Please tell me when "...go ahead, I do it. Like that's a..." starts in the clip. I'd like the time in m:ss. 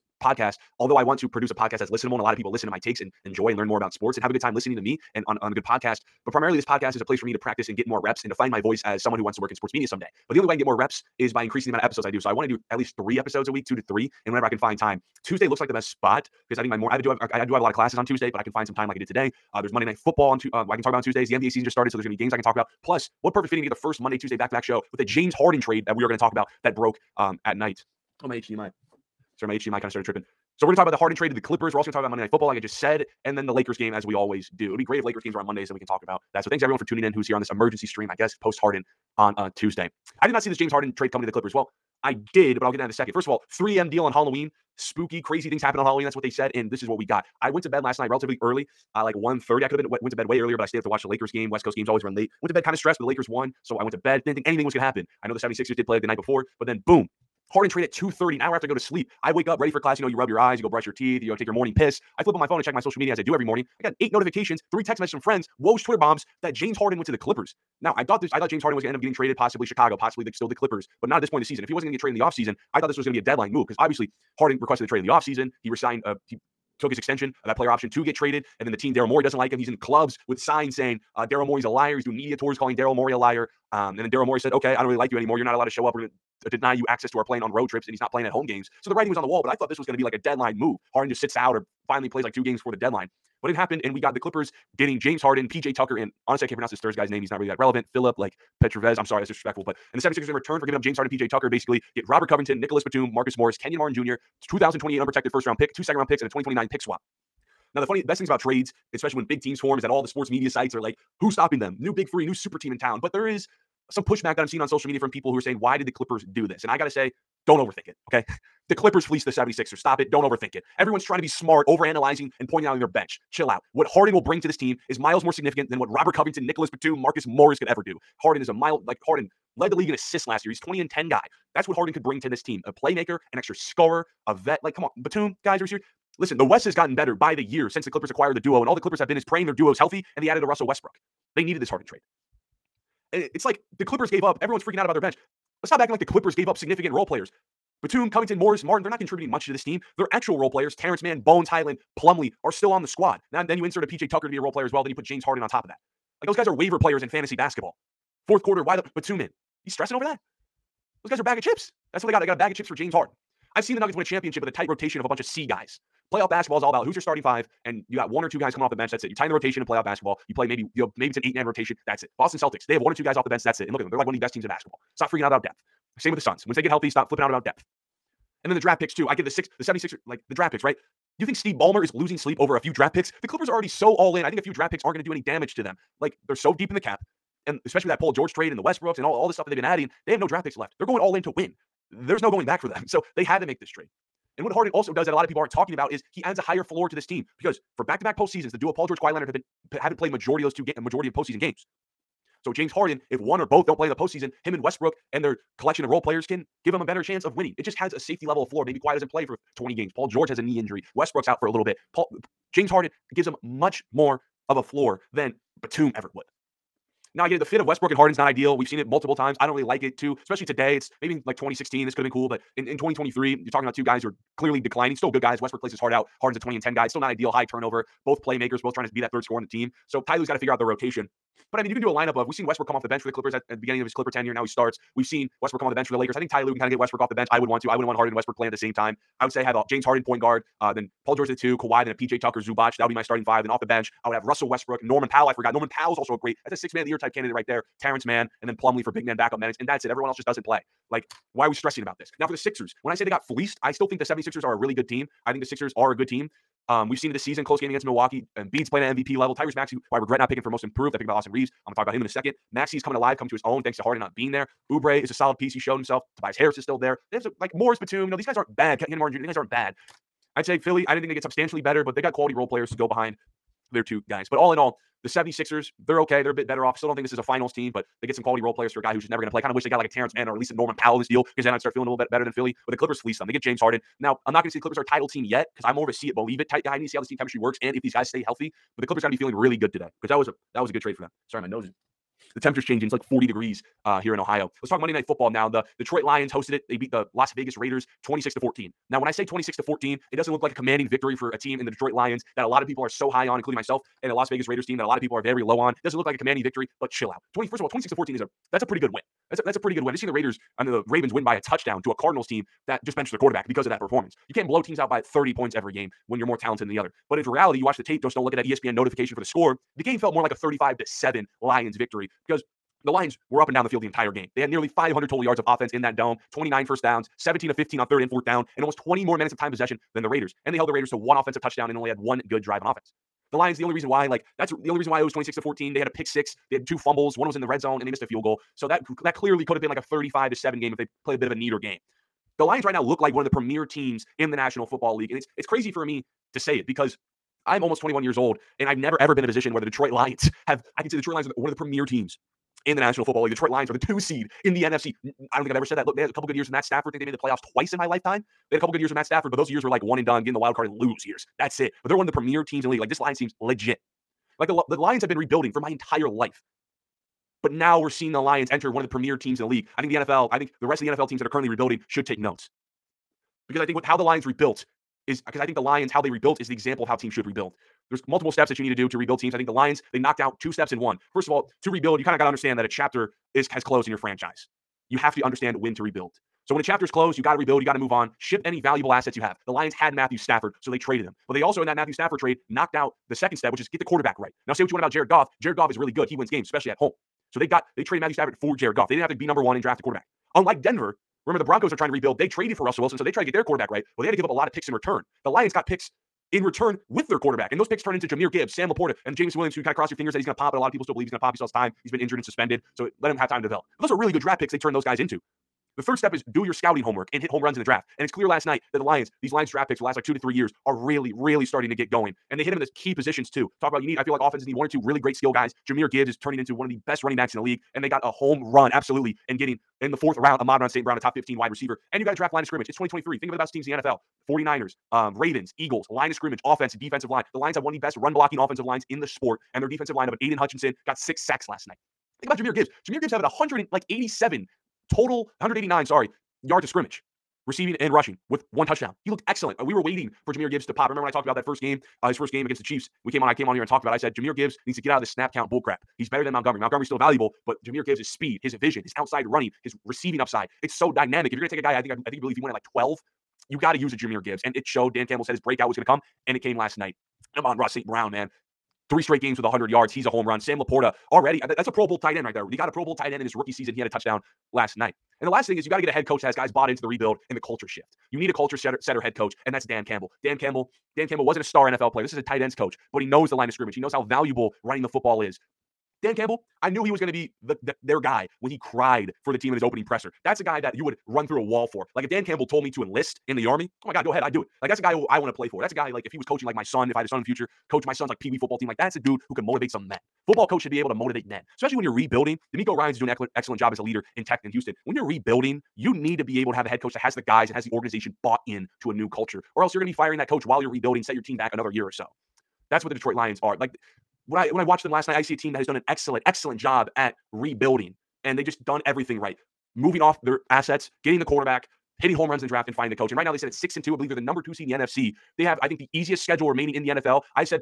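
8:14.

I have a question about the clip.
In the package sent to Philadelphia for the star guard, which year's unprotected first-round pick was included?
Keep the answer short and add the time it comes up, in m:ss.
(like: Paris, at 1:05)
2028, at 1:44.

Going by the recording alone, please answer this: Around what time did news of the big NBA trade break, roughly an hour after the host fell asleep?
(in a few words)
2:30.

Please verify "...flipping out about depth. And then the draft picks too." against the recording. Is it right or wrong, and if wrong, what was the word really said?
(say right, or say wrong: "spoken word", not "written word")
right.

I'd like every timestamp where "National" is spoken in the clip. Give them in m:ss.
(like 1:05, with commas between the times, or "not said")
5:44, 5:52.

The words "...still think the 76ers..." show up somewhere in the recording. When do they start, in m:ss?
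4:13.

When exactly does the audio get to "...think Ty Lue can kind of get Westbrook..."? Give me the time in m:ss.
3:56.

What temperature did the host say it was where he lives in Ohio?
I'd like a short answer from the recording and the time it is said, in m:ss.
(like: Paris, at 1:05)
40 degrees, at 4:53.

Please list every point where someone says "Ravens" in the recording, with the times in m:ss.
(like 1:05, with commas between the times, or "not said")
5:10, 7:15.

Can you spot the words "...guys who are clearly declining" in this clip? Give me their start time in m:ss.
3:43.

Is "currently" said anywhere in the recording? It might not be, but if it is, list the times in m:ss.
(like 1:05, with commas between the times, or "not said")
6:11.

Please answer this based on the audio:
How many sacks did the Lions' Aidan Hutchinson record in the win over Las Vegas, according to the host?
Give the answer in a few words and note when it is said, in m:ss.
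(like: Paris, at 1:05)
6, at 7:20.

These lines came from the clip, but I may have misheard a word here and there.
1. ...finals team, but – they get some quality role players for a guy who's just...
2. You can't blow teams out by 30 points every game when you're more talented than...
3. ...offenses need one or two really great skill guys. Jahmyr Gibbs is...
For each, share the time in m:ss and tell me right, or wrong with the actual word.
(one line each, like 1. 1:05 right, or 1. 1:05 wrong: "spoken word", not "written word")
1. 4:37 right
2. 5:14 right
3. 7:04 right.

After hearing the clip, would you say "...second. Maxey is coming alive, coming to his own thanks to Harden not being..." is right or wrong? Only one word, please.
right.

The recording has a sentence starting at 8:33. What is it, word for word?
Like when I when I watched them last night, I see a team that has done an excellent, excellent job at rebuilding.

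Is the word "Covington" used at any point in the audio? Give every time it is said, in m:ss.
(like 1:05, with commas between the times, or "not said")
1:42, 2:06, 2:28.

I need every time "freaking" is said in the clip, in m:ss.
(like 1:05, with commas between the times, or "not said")
2:24, 2:55.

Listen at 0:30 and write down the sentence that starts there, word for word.
So we're going to talk about the Harden trade to the Clippers.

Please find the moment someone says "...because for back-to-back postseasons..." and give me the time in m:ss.
3:17.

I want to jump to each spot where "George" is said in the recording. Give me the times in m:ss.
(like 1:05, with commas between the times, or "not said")
3:08, 3:18, 3:30, 4:01.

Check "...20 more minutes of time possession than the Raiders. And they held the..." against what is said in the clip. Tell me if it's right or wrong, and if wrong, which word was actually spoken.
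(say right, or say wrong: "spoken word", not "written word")
right.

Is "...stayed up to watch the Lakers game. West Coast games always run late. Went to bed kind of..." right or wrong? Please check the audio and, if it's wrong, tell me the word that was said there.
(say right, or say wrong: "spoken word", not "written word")
right.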